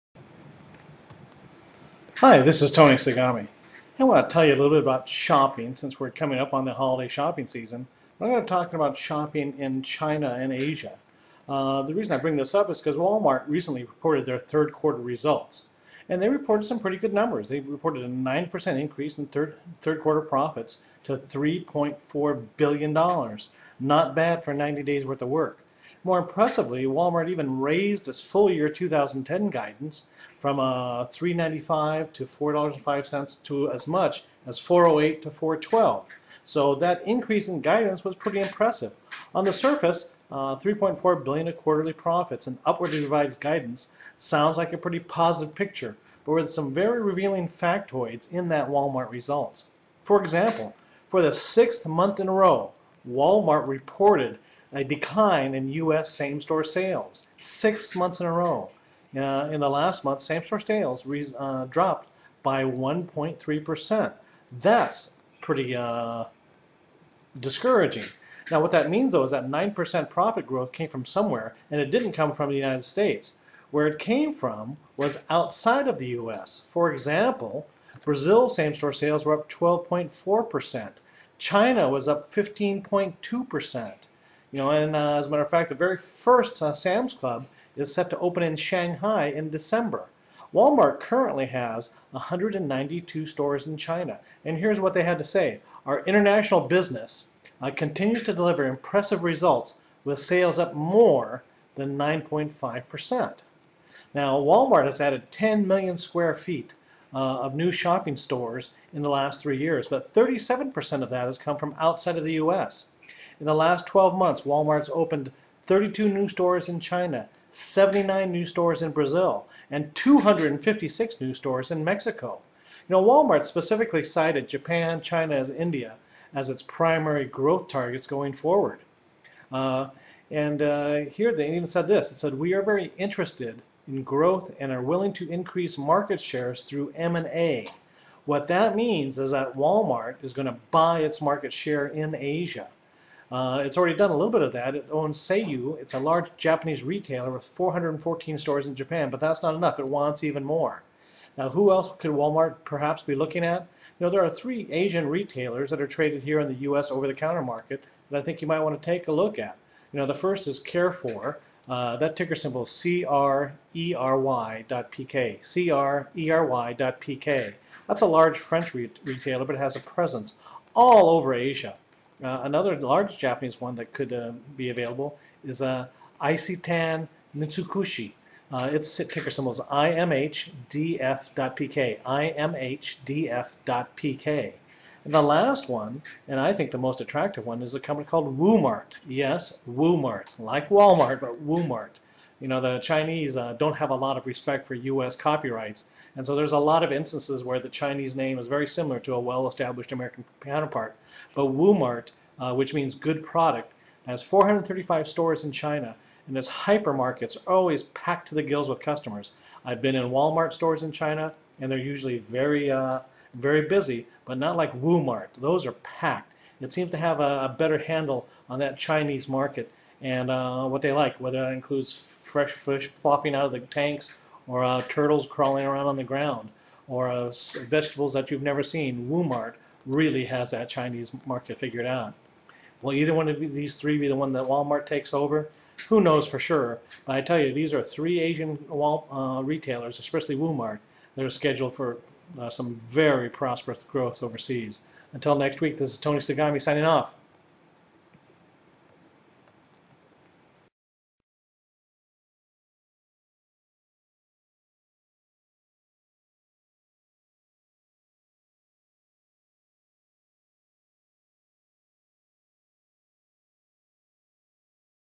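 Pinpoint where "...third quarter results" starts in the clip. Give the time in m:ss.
0:14.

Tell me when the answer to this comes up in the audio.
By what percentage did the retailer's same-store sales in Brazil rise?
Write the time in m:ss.
1:19.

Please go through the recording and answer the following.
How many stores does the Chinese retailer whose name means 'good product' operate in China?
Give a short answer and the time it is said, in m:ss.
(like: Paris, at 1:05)
435, at 3:24.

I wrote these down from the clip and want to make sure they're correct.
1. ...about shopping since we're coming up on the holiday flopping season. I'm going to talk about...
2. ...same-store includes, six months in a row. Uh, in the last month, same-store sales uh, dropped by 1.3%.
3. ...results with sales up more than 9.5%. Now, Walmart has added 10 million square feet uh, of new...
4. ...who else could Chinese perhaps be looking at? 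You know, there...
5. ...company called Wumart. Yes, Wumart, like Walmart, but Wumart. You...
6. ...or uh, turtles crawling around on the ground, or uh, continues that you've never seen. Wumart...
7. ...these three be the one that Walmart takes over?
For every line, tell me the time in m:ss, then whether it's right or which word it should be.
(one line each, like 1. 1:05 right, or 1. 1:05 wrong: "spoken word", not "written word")
1. 0:04 wrong: "shopping", not "flopping"
2. 0:56 wrong: "sales", not "includes"
3. 1:39 right
4. 2:31 wrong: "Walmart", not "Chinese"
5. 3:07 right
6. 3:44 wrong: "vegetables", not "continues"
7. 3:53 right.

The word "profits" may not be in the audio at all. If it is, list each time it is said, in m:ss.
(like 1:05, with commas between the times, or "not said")
0:20, 0:41, 1:10.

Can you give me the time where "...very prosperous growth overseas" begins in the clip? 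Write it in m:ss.
4:02.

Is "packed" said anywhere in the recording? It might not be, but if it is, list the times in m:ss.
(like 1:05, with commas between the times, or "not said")
3:27, 3:35.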